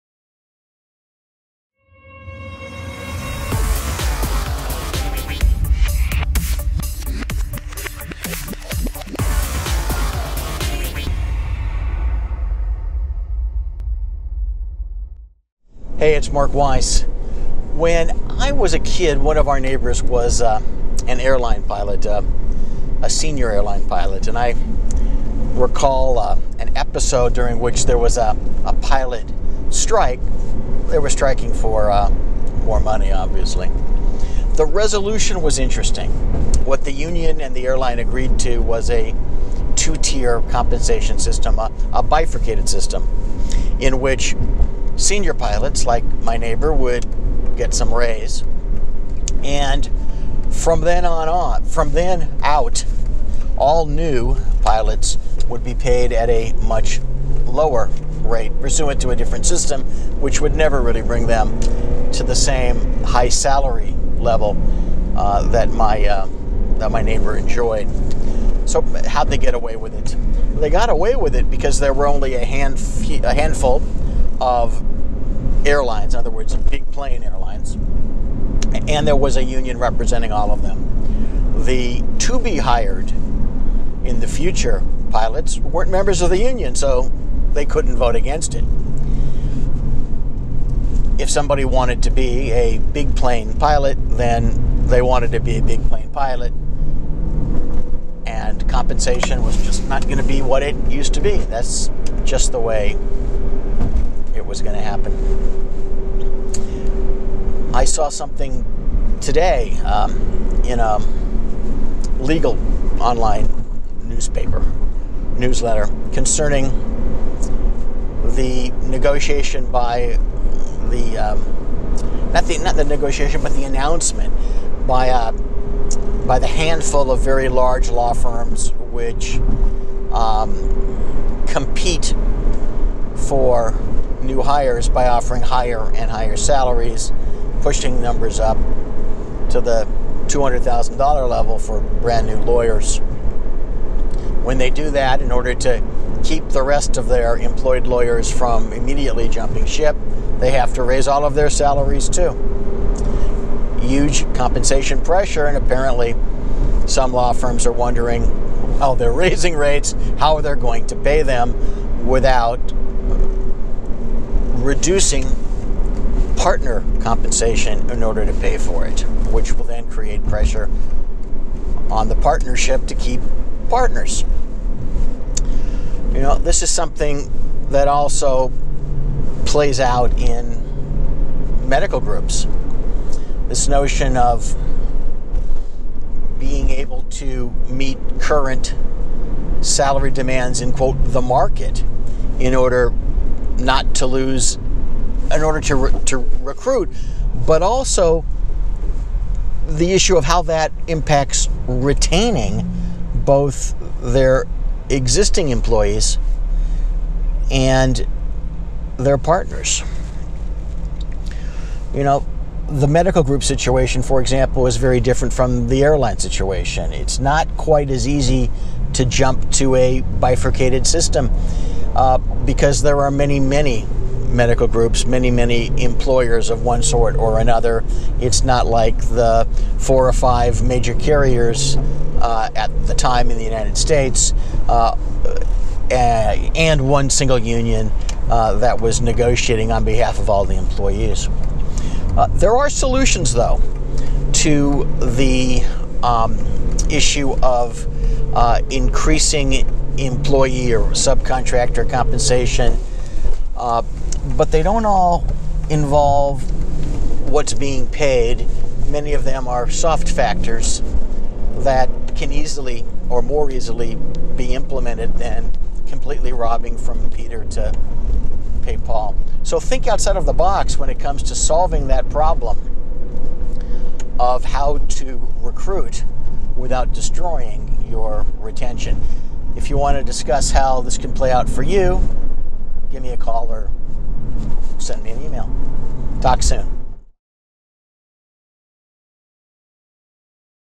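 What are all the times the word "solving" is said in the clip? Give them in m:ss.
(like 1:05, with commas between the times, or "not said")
4:31.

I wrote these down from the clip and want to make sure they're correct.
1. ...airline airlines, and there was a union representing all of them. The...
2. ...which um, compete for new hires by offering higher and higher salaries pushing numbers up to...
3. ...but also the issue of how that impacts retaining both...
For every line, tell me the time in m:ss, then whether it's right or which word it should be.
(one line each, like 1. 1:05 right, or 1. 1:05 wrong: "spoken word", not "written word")
1. 1:16 wrong: "plane", not "airline"
2. 2:08 right
3. 3:17 right.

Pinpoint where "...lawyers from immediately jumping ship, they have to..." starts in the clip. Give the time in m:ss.
2:27.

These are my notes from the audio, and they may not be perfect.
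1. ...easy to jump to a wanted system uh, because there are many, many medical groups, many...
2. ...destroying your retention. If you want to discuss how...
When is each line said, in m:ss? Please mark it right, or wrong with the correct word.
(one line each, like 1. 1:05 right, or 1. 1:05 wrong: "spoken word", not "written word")
1. 3:38 wrong: "bifurcated", not "wanted"
2. 4:36 right.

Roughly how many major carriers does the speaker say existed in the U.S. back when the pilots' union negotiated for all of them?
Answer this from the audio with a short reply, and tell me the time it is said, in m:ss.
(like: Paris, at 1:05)
4 or 5, at 3:49.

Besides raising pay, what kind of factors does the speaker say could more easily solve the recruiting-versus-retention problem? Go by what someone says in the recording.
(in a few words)
Soft factors.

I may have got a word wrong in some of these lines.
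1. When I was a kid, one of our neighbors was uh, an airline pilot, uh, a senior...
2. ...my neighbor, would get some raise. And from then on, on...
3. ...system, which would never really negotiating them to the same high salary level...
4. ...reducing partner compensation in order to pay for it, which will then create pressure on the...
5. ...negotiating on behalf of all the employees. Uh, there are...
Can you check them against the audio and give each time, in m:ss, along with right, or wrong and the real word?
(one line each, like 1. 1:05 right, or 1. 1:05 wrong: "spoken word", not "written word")
1. 0:17 right
2. 0:46 right
3. 0:59 wrong: "bring", not "negotiating"
4. 2:44 right
5. 3:59 right.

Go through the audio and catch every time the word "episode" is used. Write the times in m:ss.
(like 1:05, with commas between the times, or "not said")
0:26.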